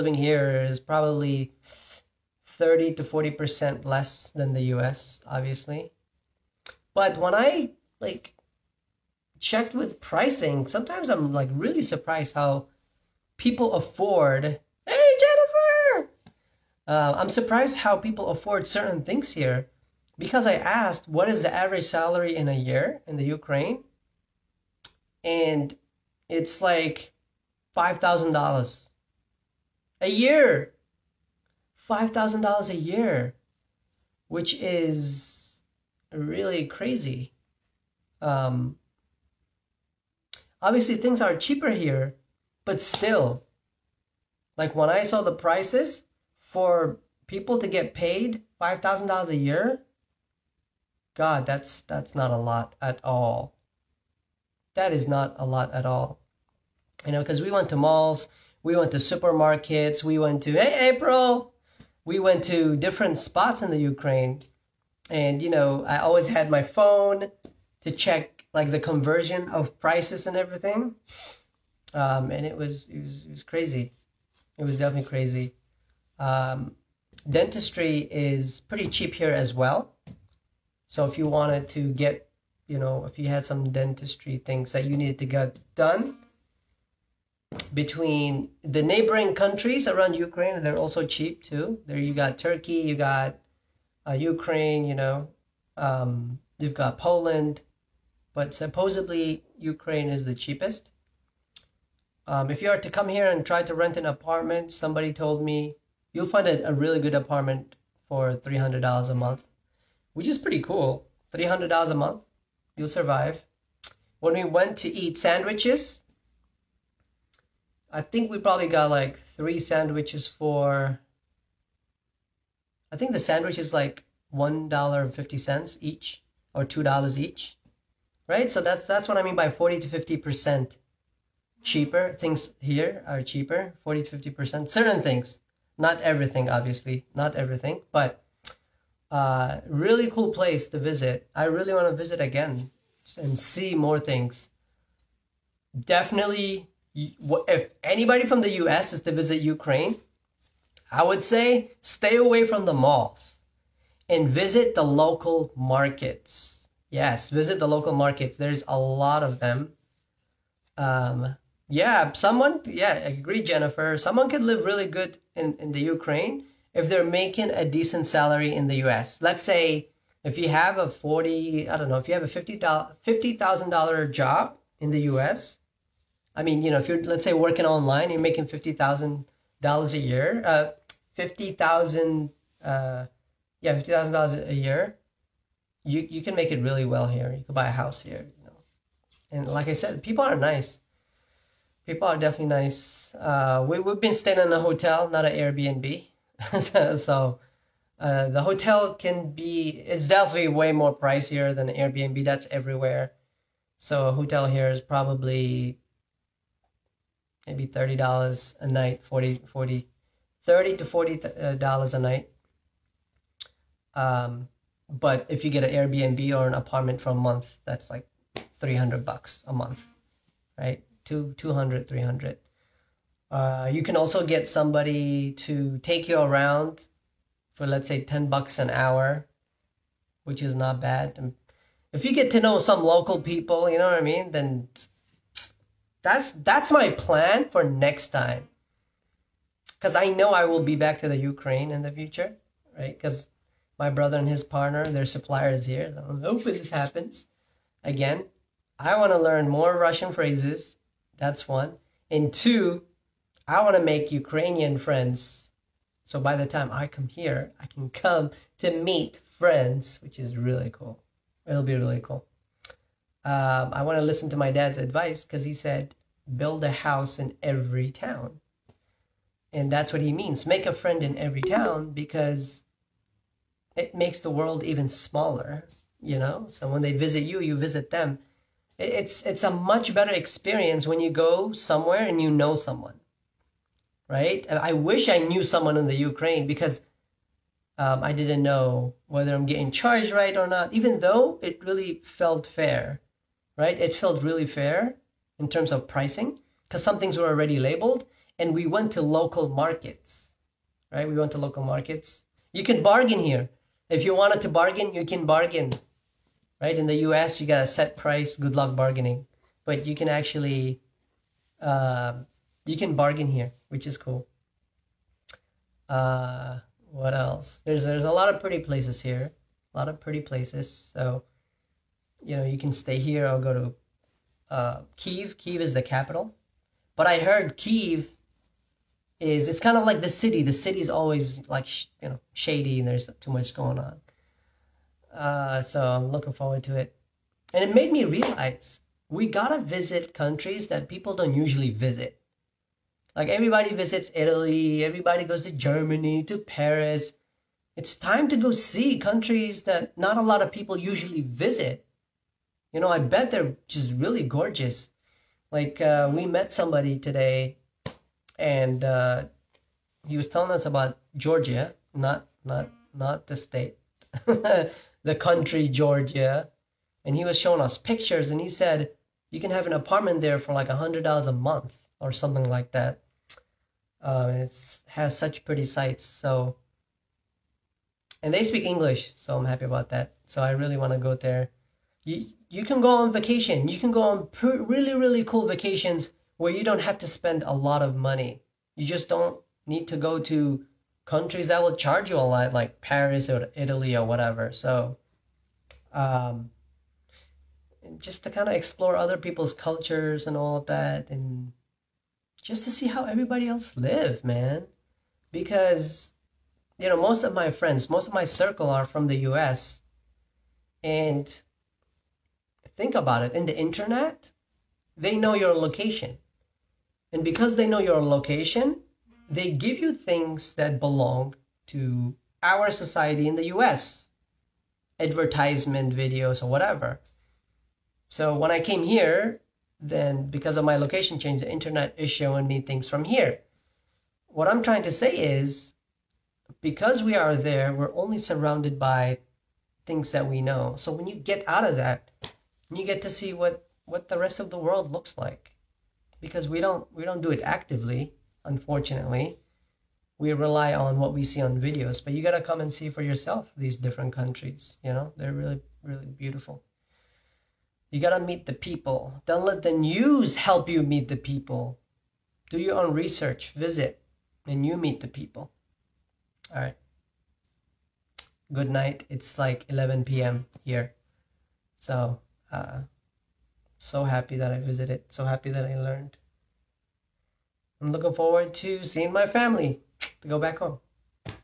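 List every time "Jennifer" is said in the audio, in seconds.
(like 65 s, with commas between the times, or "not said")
15 s, 163 s.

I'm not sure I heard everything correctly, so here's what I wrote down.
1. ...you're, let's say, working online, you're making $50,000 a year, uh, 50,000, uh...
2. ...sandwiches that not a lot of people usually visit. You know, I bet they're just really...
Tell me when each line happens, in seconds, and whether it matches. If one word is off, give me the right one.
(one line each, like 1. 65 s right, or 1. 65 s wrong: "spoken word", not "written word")
1. 176 s right
2. 348 s wrong: "countries", not "sandwiches".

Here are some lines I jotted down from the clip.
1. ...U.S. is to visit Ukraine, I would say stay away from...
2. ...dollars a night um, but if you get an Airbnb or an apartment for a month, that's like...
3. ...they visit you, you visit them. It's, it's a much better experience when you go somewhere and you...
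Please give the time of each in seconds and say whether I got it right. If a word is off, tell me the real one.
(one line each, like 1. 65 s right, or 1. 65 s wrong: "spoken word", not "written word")
1. 148 s right
2. 211 s right
3. 276 s right.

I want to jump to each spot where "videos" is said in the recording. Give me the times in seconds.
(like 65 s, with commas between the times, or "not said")
425 s, 451 s.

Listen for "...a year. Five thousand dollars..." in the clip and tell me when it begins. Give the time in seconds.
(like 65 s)
29 s.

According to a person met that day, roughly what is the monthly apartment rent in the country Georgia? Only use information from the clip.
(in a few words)
$100.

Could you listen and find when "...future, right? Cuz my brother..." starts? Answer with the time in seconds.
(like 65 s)
241 s.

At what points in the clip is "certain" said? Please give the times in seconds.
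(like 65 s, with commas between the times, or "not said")
18 s, 134 s.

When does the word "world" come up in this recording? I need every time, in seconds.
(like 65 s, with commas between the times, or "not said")
274 s, 444 s.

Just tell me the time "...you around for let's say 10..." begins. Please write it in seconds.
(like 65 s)
226 s.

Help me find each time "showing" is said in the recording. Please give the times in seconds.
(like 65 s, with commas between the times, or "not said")
367 s, 432 s.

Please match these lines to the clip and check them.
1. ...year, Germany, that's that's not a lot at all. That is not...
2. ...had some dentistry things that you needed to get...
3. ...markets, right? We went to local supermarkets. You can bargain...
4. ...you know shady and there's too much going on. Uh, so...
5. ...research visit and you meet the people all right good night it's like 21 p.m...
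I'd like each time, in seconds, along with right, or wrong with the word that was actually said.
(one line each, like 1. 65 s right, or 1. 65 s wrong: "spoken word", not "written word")
1. 49 s wrong: "God", not "Germany"
2. 83 s right
3. 299 s wrong: "markets", not "supermarkets"
4. 332 s right
5. 462 s wrong: "11", not "21".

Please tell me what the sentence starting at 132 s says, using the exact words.
Things here are cheaper, 40 to 50%.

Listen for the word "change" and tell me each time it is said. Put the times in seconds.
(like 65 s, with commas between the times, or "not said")
431 s.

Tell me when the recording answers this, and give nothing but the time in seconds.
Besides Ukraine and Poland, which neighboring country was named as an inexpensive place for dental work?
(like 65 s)
92 s.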